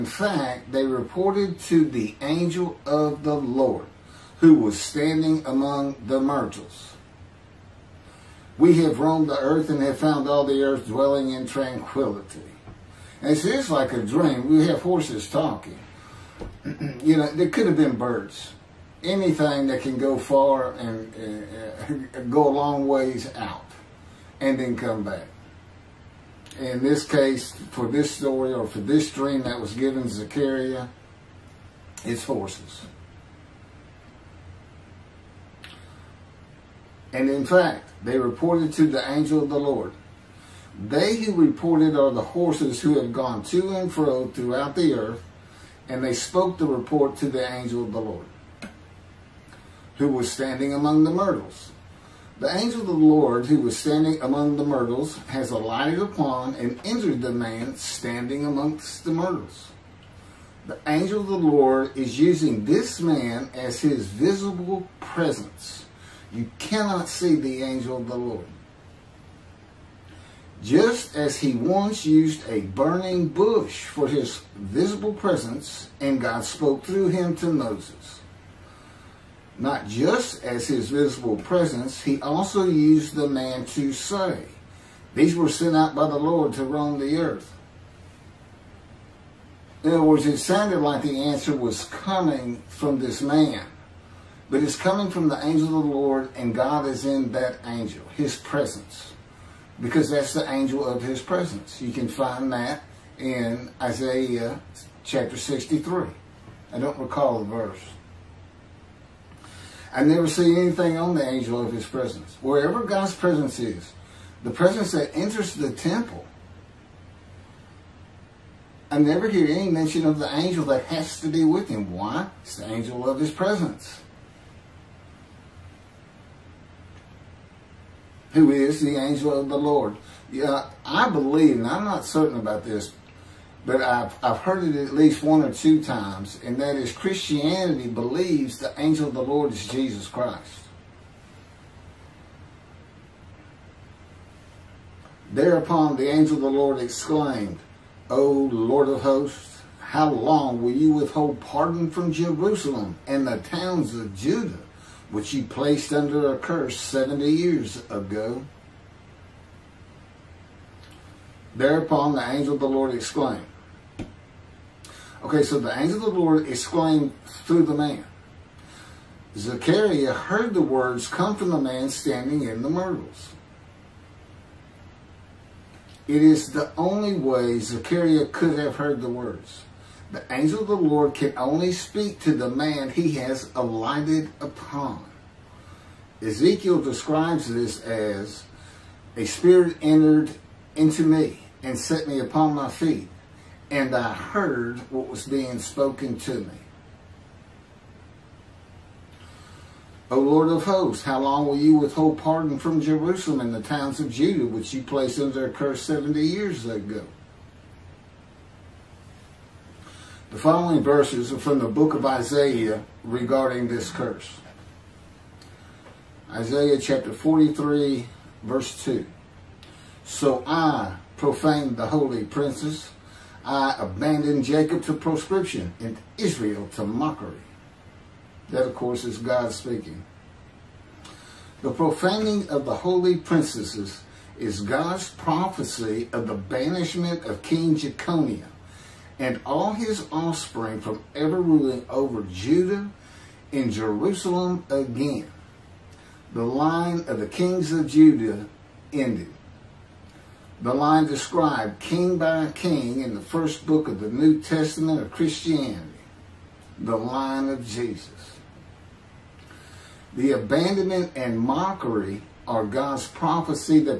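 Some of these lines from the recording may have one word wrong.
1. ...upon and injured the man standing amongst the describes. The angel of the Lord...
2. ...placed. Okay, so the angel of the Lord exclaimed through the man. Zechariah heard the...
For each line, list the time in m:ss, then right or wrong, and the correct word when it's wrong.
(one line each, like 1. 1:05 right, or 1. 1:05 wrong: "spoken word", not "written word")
1. 0:55 wrong: "myrtles", not "describes"
2. 2:42 wrong: "exclaimed", not "placed".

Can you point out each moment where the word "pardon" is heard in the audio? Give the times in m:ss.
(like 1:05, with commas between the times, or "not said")
2:31, 3:22.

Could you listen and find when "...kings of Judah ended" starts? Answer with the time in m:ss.
4:07.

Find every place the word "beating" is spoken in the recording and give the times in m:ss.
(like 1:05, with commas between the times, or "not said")
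not said.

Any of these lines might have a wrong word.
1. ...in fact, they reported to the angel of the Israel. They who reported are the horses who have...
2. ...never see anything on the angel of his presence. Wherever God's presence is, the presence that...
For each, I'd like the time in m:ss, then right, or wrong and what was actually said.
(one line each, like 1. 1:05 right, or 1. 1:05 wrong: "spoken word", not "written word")
1. 0:37 wrong: "Lord", not "Israel"
2. 1:50 right.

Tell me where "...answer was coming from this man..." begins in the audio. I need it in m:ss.
1:31.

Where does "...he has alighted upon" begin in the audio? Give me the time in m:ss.
3:02.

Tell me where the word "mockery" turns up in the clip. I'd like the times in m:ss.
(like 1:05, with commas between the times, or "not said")
3:46, 4:21.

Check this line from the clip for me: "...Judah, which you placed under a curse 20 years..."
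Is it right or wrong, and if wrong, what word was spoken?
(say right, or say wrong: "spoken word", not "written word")
wrong: "70", not "20".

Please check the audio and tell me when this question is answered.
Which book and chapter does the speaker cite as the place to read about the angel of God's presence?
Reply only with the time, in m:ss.
1:43.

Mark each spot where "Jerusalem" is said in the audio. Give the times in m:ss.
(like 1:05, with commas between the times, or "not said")
2:32, 3:22, 4:03.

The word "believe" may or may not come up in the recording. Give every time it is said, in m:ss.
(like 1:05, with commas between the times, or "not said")
2:11, 2:17.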